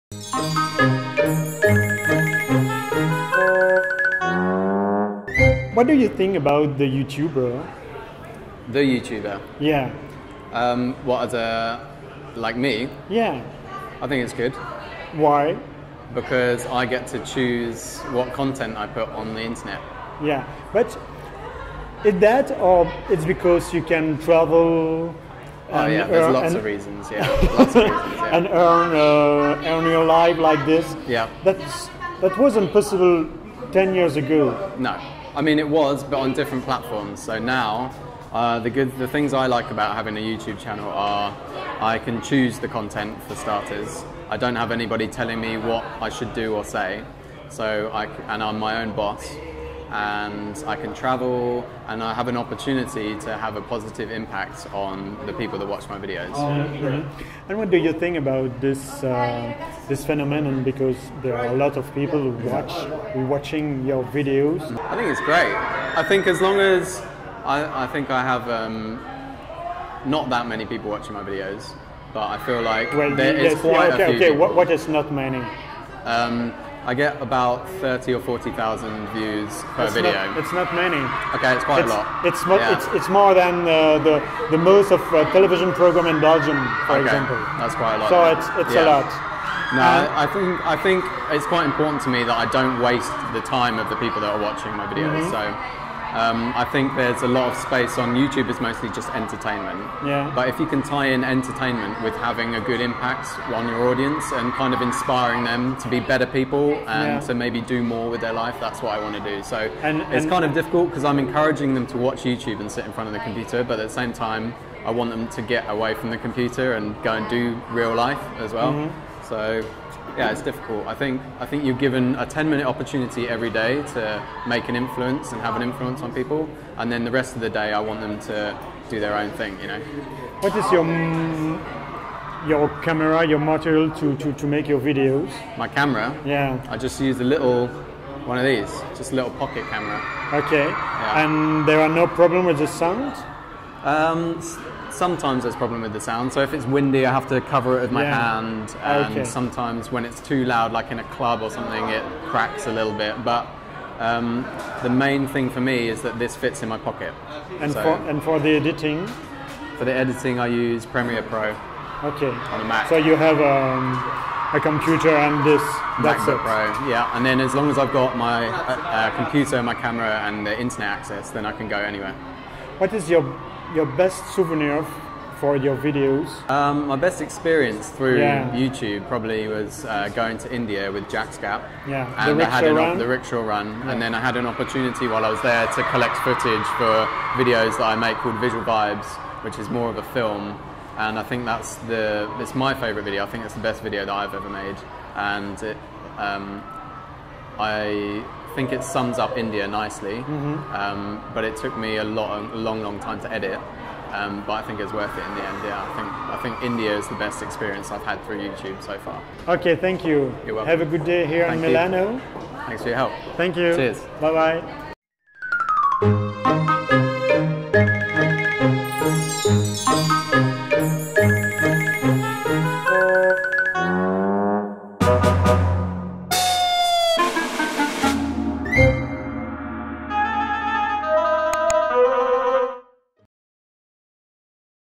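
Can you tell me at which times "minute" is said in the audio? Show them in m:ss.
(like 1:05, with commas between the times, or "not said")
2:02.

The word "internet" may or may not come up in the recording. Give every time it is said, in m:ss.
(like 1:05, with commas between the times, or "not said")
0:19, 2:50.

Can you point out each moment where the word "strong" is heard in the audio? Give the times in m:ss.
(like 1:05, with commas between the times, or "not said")
not said.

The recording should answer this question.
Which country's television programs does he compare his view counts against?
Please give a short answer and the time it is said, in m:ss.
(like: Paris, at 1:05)
Belgium, at 1:26.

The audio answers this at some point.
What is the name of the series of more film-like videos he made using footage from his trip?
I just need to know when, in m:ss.
3:08.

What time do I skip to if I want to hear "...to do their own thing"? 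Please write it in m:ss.
2:08.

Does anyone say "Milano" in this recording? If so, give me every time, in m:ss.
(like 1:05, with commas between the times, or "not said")
3:31.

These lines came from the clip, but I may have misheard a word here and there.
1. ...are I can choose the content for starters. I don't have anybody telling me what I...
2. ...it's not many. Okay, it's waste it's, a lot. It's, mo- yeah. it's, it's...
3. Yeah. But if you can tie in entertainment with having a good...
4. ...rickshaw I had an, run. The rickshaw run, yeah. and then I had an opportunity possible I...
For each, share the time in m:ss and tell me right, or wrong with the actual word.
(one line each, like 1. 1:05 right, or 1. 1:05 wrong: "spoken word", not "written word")
1. 0:40 right
2. 1:20 wrong: "quite", not "waste"
3. 1:40 right
4. 3:02 wrong: "while", not "possible".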